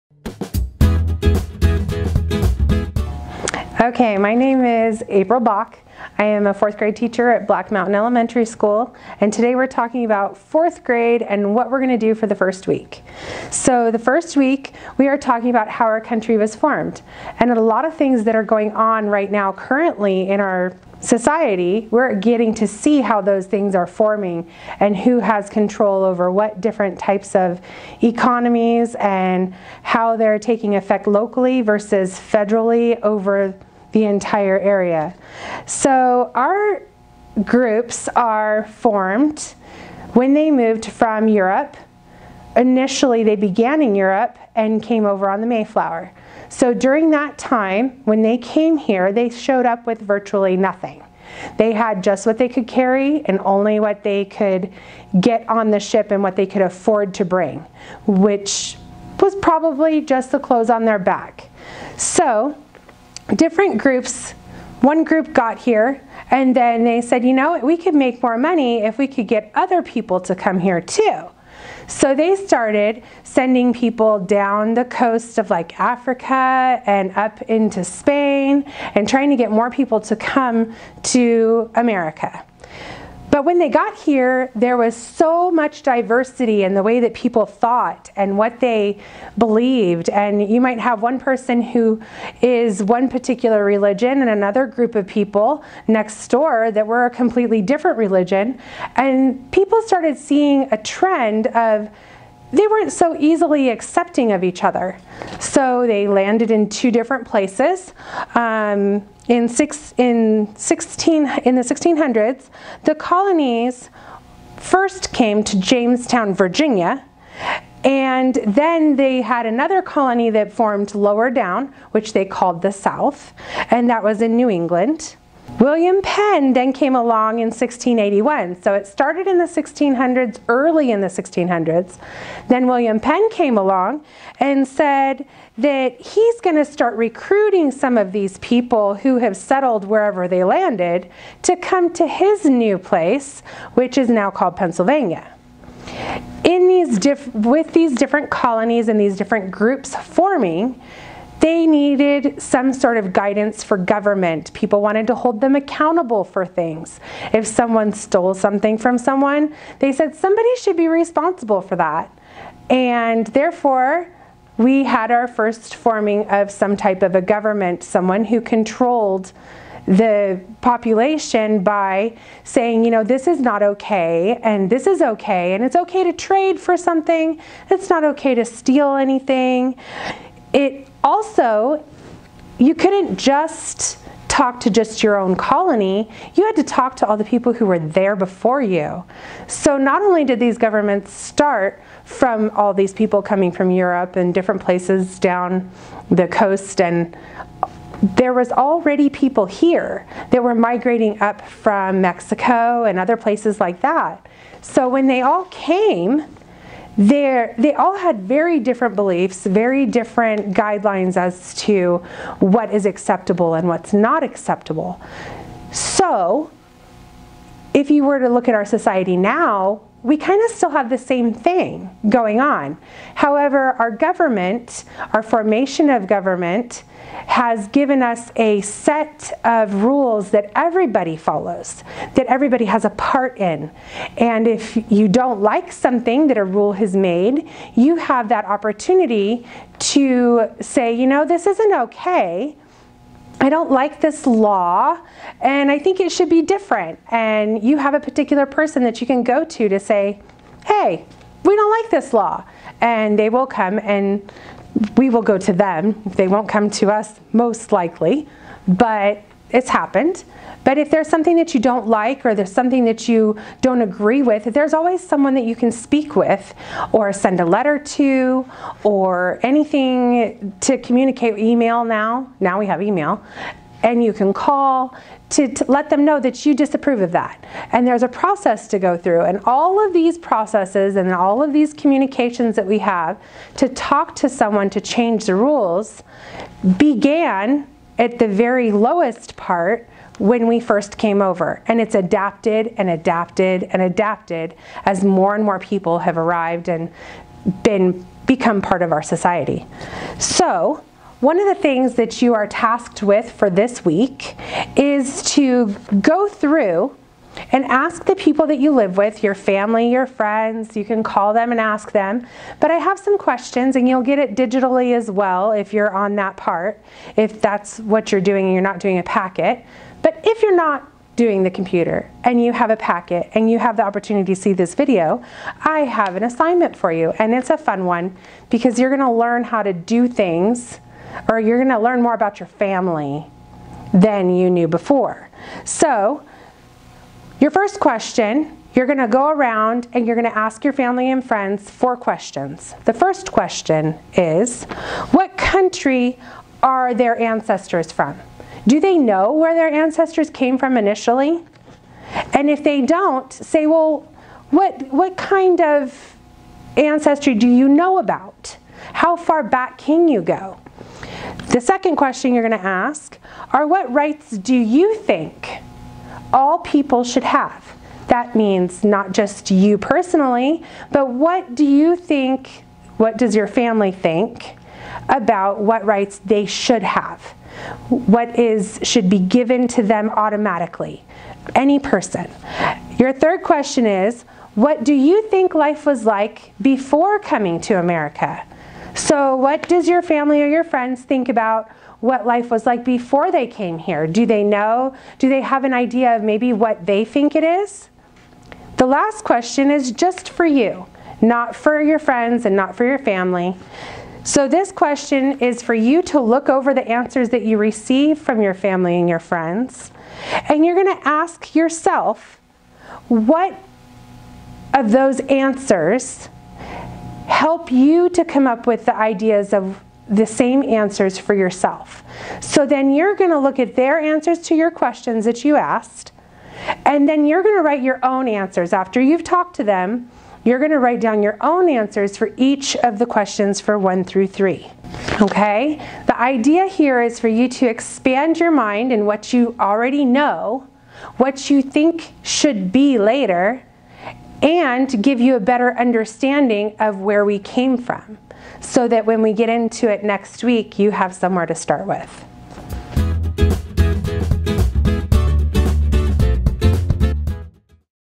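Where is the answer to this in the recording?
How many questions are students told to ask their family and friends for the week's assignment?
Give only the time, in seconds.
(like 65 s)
341 s.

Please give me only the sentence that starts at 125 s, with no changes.
William Penn then came along in 1681.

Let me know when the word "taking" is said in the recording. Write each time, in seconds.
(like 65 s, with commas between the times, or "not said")
30 s.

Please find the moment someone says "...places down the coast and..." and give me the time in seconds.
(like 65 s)
194 s.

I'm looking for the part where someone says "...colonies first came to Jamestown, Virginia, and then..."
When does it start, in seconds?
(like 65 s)
112 s.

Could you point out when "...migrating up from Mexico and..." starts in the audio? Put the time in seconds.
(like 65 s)
200 s.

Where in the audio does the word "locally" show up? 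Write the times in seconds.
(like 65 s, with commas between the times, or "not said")
31 s.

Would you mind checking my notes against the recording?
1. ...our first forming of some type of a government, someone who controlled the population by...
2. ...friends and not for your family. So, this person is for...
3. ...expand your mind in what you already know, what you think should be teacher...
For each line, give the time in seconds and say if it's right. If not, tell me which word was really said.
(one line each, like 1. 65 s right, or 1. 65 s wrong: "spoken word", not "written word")
1. 165 s right
2. 401 s wrong: "question", not "person"
3. 437 s wrong: "later", not "teacher".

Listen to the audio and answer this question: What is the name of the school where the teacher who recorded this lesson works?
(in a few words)
Black Mountain Elementary School.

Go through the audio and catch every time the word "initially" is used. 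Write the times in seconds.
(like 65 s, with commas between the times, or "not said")
42 s, 350 s.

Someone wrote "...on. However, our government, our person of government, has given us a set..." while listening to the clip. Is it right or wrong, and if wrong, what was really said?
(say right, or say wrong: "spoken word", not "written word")
wrong: "formation", not "person".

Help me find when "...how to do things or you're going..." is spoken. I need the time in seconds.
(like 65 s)
329 s.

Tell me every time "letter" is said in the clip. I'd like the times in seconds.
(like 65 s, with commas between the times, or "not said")
267 s.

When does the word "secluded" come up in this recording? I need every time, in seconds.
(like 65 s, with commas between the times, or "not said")
not said.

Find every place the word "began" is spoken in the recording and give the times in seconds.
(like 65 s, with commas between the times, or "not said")
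43 s, 286 s.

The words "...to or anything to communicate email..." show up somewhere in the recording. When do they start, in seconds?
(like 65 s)
267 s.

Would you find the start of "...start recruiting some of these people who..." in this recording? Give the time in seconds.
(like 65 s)
136 s.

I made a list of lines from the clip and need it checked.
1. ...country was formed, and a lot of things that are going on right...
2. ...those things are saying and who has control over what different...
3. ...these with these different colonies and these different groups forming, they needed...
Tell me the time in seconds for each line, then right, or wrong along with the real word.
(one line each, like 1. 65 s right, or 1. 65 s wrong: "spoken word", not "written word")
1. 15 s right
2. 23 s wrong: "forming", not "saying"
3. 146 s right.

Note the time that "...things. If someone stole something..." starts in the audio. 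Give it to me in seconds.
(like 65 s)
156 s.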